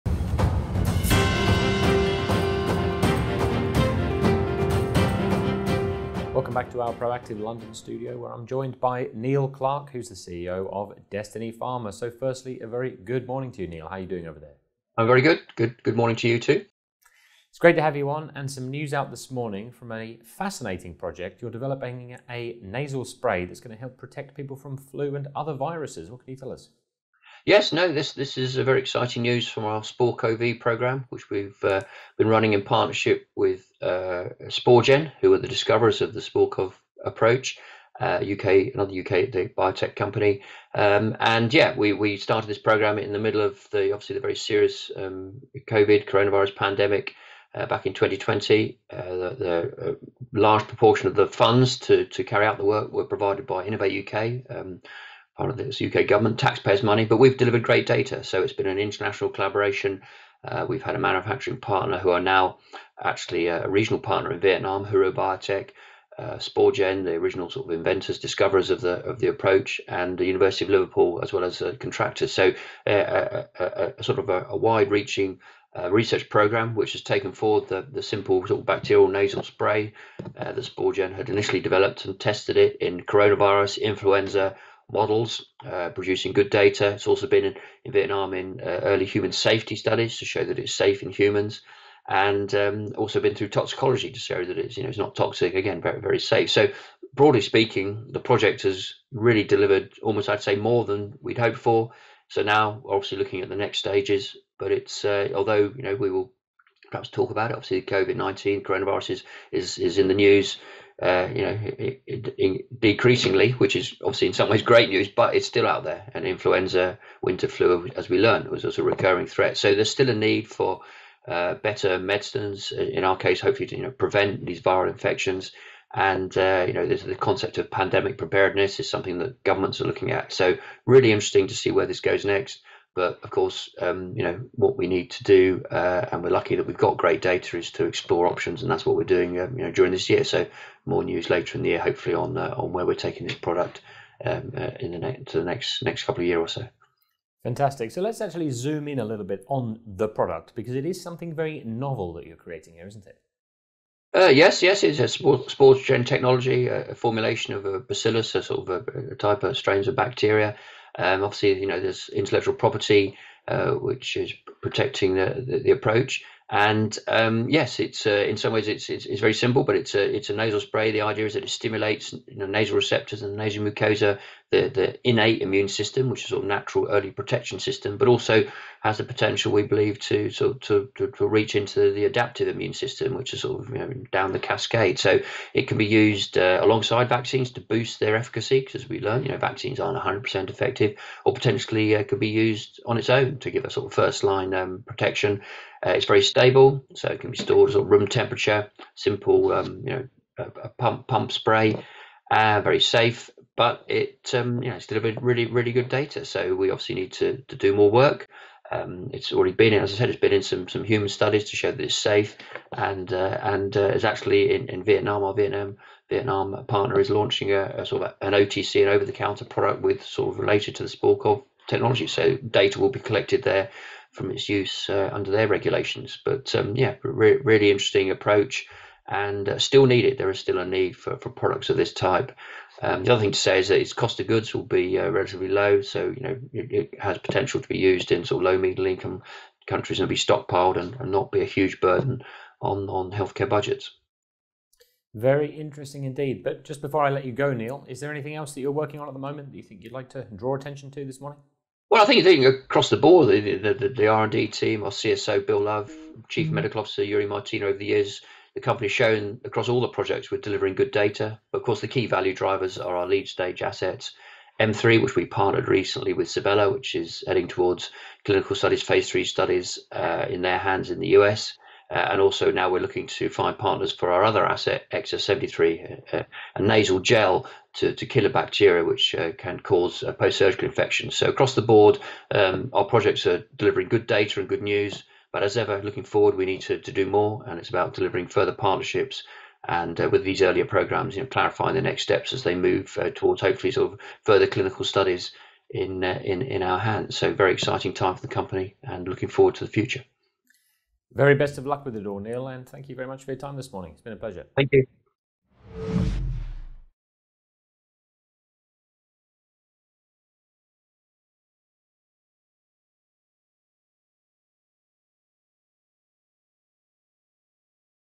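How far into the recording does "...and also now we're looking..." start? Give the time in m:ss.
4:32.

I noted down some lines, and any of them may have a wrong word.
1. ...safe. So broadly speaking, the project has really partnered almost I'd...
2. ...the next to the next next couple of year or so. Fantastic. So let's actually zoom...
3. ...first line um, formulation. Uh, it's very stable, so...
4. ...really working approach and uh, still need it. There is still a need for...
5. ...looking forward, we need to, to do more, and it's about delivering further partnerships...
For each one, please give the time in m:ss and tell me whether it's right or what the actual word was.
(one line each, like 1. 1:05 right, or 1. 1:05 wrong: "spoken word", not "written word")
1. 1:36 wrong: "delivered", not "partnered"
2. 2:24 right
3. 3:13 wrong: "protection", not "formulation"
4. 3:47 wrong: "interesting", not "working"
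5. 4:45 right.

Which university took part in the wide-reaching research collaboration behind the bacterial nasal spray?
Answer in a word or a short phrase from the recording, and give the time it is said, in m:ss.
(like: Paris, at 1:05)
University of Liverpool, at 1:10.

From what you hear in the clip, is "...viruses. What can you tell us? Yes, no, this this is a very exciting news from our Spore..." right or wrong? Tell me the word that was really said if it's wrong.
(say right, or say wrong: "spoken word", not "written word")
right.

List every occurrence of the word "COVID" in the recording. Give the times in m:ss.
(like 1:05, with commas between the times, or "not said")
0:45, 1:47.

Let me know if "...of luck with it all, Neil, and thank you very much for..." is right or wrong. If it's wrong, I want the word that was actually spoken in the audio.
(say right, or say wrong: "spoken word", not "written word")
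right.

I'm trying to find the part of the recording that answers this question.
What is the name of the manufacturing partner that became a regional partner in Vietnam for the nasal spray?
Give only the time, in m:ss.
1:04.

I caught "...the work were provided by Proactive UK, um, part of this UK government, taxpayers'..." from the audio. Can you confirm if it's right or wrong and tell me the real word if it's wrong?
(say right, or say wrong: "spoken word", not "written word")
wrong: "Innovate", not "Proactive".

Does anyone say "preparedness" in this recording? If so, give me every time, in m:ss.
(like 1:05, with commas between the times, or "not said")
2:08.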